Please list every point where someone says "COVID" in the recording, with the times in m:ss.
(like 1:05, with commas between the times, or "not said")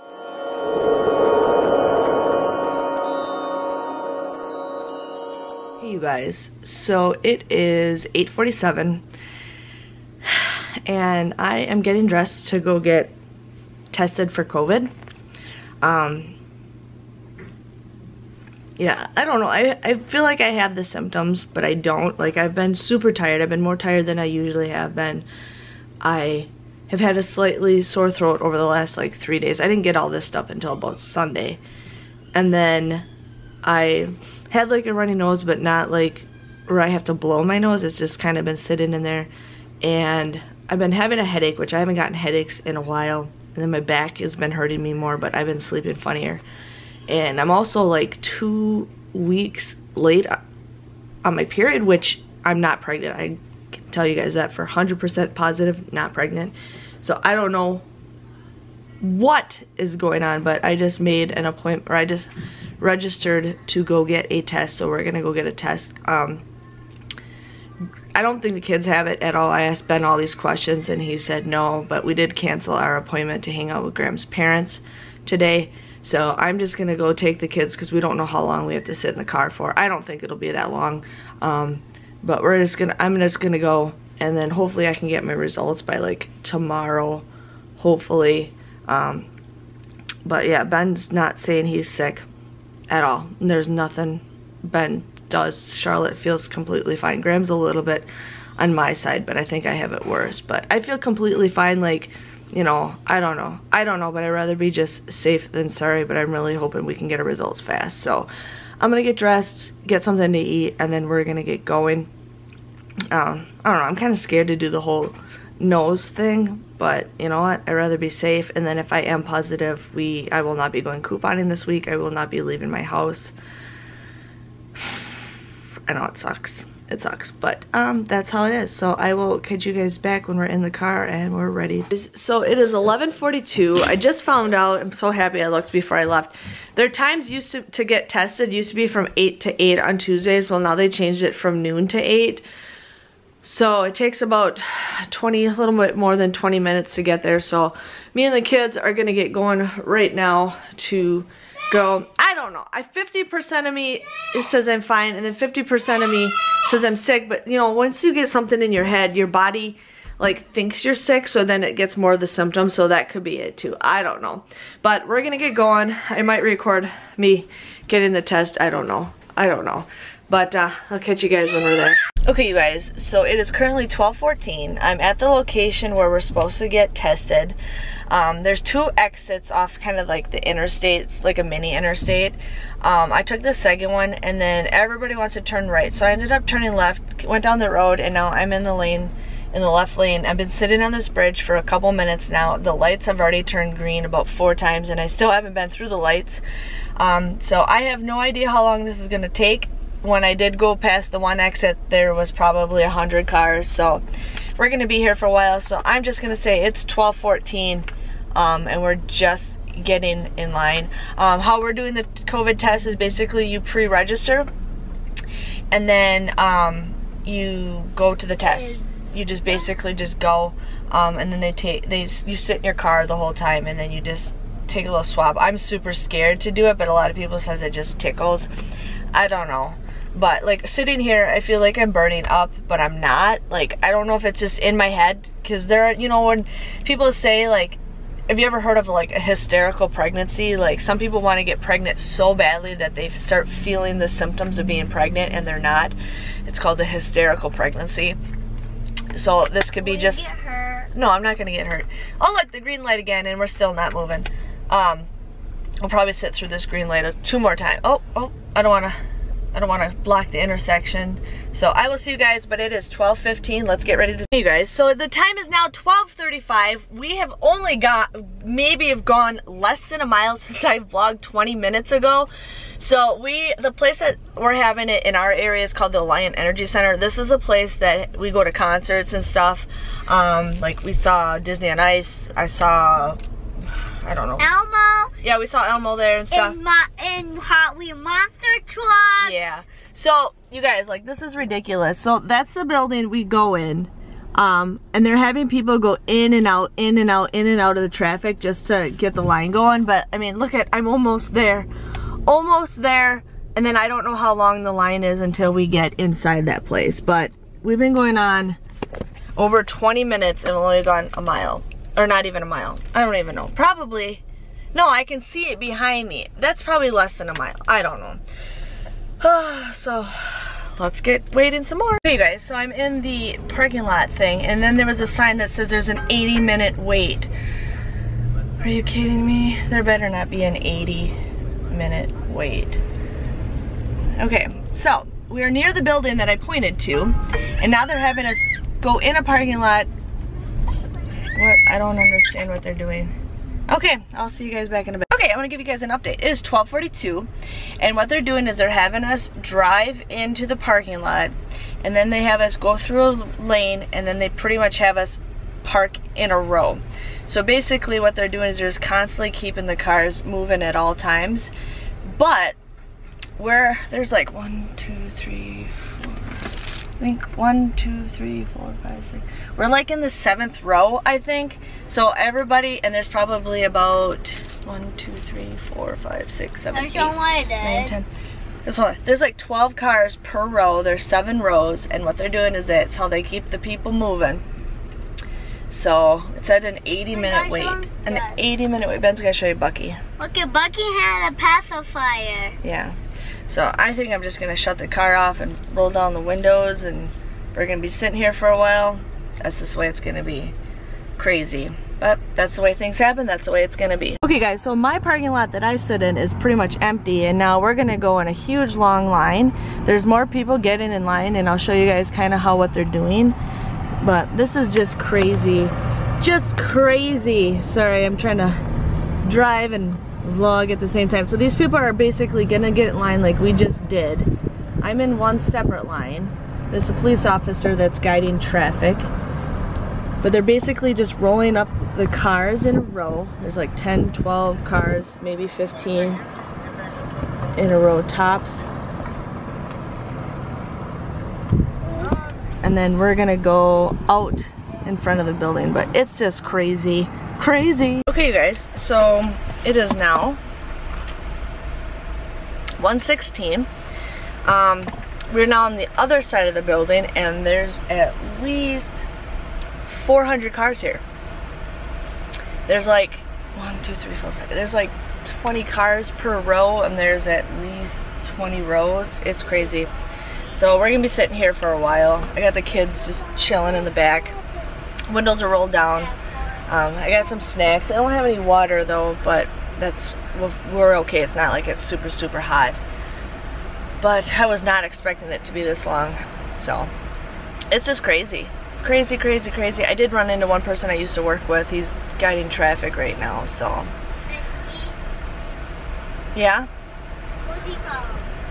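0:14, 3:32.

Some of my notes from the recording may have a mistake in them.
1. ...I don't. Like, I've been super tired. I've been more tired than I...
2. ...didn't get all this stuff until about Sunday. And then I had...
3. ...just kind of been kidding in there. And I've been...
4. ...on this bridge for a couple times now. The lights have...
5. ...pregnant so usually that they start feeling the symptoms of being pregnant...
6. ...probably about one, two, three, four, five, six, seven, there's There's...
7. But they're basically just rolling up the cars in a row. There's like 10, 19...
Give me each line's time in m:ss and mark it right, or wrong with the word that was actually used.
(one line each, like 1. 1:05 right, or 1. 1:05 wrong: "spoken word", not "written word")
1. 0:21 right
2. 0:29 right
3. 0:37 wrong: "sitting", not "kidding"
4. 3:10 wrong: "minutes", not "times"
5. 4:01 wrong: "badly", not "usually"
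6. 6:13 right
7. 7:10 wrong: "12", not "19".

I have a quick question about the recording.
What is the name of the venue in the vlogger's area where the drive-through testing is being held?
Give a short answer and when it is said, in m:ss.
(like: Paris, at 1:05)
Alliant Energy Center, at 4:36.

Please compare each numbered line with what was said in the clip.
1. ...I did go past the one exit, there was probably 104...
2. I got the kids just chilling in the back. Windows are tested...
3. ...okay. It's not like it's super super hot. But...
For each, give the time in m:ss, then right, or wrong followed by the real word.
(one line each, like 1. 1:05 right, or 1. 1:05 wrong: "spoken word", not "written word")
1. 3:20 wrong: "100", not "104"
2. 7:52 wrong: "rolled", not "tested"
3. 8:01 right.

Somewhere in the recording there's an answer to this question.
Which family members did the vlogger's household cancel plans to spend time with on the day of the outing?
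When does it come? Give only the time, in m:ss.
1:13.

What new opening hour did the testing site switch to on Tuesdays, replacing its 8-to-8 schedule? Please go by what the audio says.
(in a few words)
Noon.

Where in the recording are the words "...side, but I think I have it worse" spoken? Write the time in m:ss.
1:38.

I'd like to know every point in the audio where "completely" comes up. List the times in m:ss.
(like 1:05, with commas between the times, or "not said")
1:36, 1:40.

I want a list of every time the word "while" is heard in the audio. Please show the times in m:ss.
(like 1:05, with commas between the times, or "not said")
0:42, 3:25, 6:38, 7:51.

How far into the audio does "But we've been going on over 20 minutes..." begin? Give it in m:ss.
5:07.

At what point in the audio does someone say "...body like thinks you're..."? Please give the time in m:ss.
2:39.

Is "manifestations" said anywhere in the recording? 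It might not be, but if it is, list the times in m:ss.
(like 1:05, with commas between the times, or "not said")
not said.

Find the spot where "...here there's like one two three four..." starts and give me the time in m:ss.
7:40.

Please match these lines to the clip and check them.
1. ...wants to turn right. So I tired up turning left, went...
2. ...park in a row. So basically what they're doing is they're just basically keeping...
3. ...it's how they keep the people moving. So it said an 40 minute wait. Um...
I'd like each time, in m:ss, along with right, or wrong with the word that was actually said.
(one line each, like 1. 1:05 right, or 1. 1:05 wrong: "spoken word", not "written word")
1. 3:05 wrong: "ended", not "tired"
2. 5:55 wrong: "constantly", not "basically"
3. 6:22 wrong: "80", not "40".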